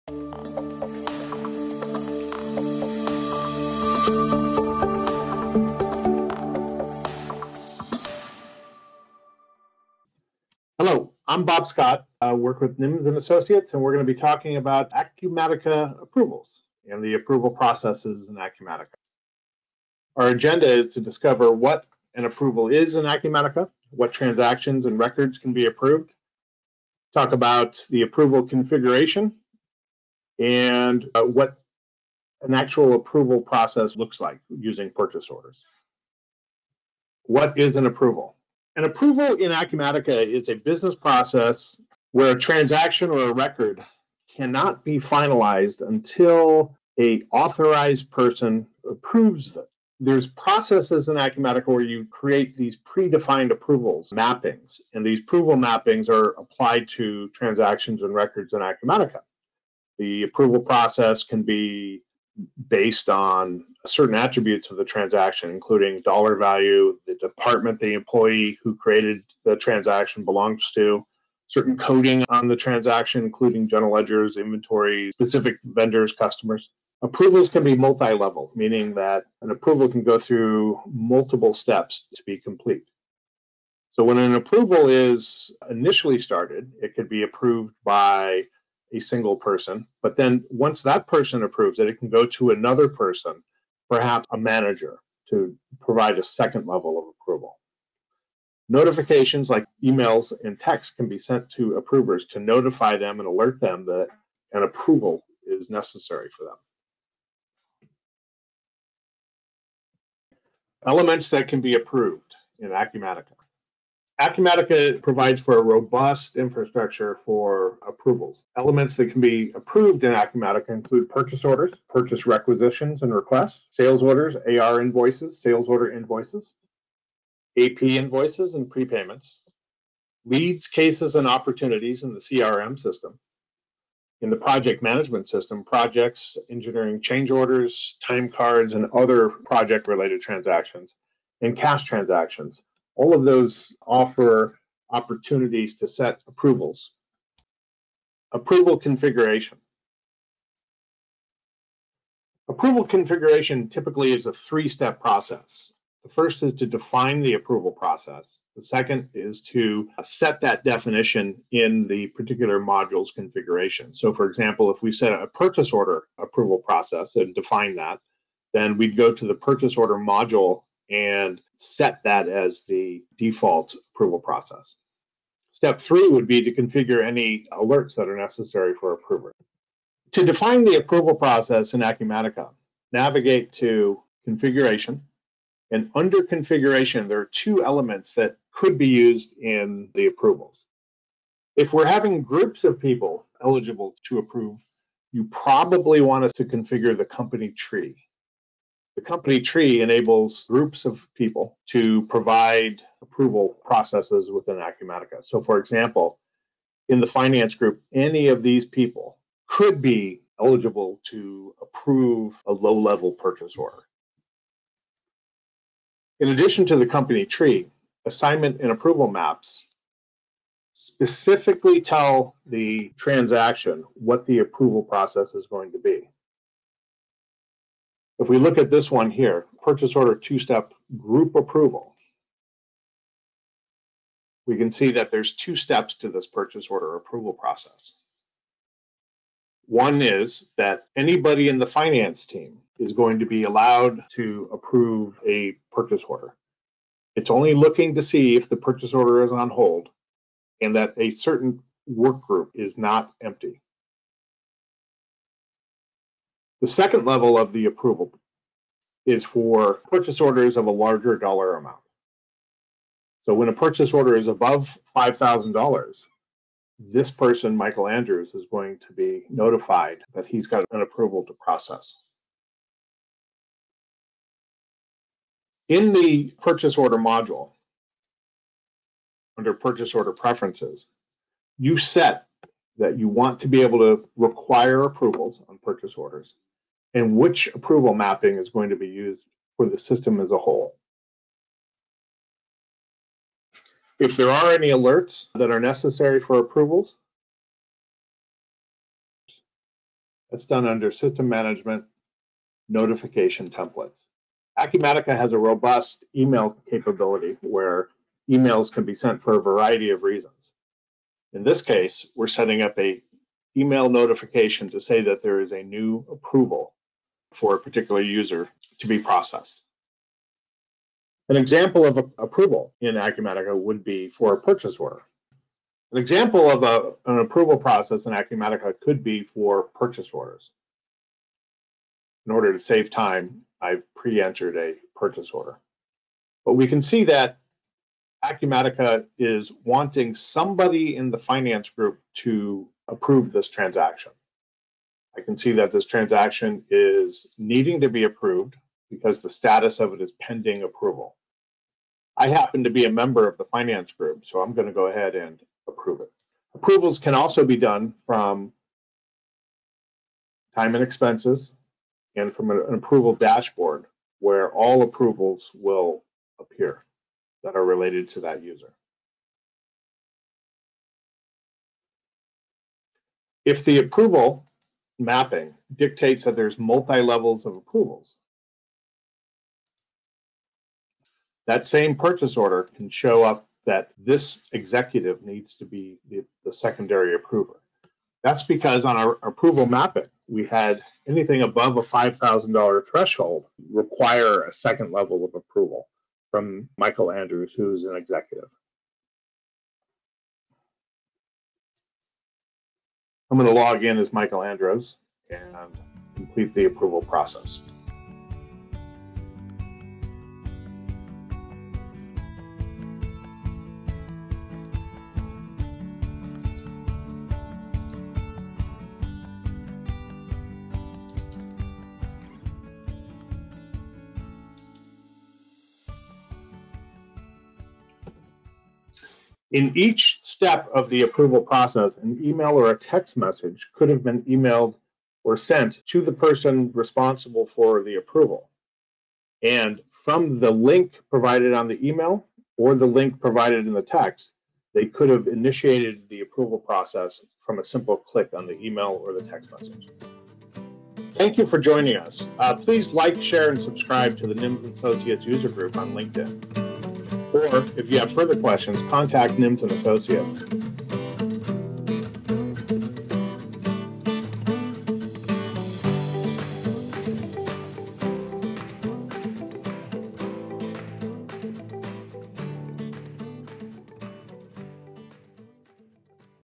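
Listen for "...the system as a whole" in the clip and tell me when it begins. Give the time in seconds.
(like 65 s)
289 s.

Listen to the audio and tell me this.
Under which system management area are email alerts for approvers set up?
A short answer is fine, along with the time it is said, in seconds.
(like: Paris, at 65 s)
notification templates, at 302 s.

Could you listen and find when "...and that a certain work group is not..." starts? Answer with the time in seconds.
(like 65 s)
250 s.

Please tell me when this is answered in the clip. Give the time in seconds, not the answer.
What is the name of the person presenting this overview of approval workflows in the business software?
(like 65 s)
11 s.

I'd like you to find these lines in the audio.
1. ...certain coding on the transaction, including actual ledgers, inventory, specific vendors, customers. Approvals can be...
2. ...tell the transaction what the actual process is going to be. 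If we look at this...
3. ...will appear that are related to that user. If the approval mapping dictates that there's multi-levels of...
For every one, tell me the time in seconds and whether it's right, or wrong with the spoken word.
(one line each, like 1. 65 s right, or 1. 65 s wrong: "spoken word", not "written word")
1. 71 s wrong: "general", not "actual"
2. 221 s wrong: "approval", not "actual"
3. 365 s right.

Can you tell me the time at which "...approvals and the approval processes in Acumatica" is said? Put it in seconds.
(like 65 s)
16 s.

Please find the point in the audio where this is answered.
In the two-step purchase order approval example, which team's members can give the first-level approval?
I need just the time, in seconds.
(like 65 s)
241 s.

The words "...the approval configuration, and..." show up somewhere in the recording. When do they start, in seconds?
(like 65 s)
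27 s.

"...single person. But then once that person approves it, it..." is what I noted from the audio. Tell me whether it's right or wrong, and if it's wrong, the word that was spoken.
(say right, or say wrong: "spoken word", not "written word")
right.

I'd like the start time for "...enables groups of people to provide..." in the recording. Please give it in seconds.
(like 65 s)
199 s.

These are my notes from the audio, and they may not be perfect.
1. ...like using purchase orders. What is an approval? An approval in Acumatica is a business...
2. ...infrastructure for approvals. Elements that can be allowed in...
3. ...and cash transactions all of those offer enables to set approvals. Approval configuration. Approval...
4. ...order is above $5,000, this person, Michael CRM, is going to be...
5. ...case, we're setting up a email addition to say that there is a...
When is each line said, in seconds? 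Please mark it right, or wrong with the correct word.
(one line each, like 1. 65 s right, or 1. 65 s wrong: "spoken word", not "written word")
1. 34 s right
2. 116 s wrong: "approved", not "allowed"
3. 141 s wrong: "opportunities", not "enables"
4. 263 s wrong: "Andrews", not "CRM"
5. 311 s wrong: "notification", not "addition".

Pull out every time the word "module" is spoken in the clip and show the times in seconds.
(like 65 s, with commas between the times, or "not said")
162 s, 169 s, 276 s.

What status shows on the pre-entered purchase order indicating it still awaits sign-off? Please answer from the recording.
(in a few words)
pending approval.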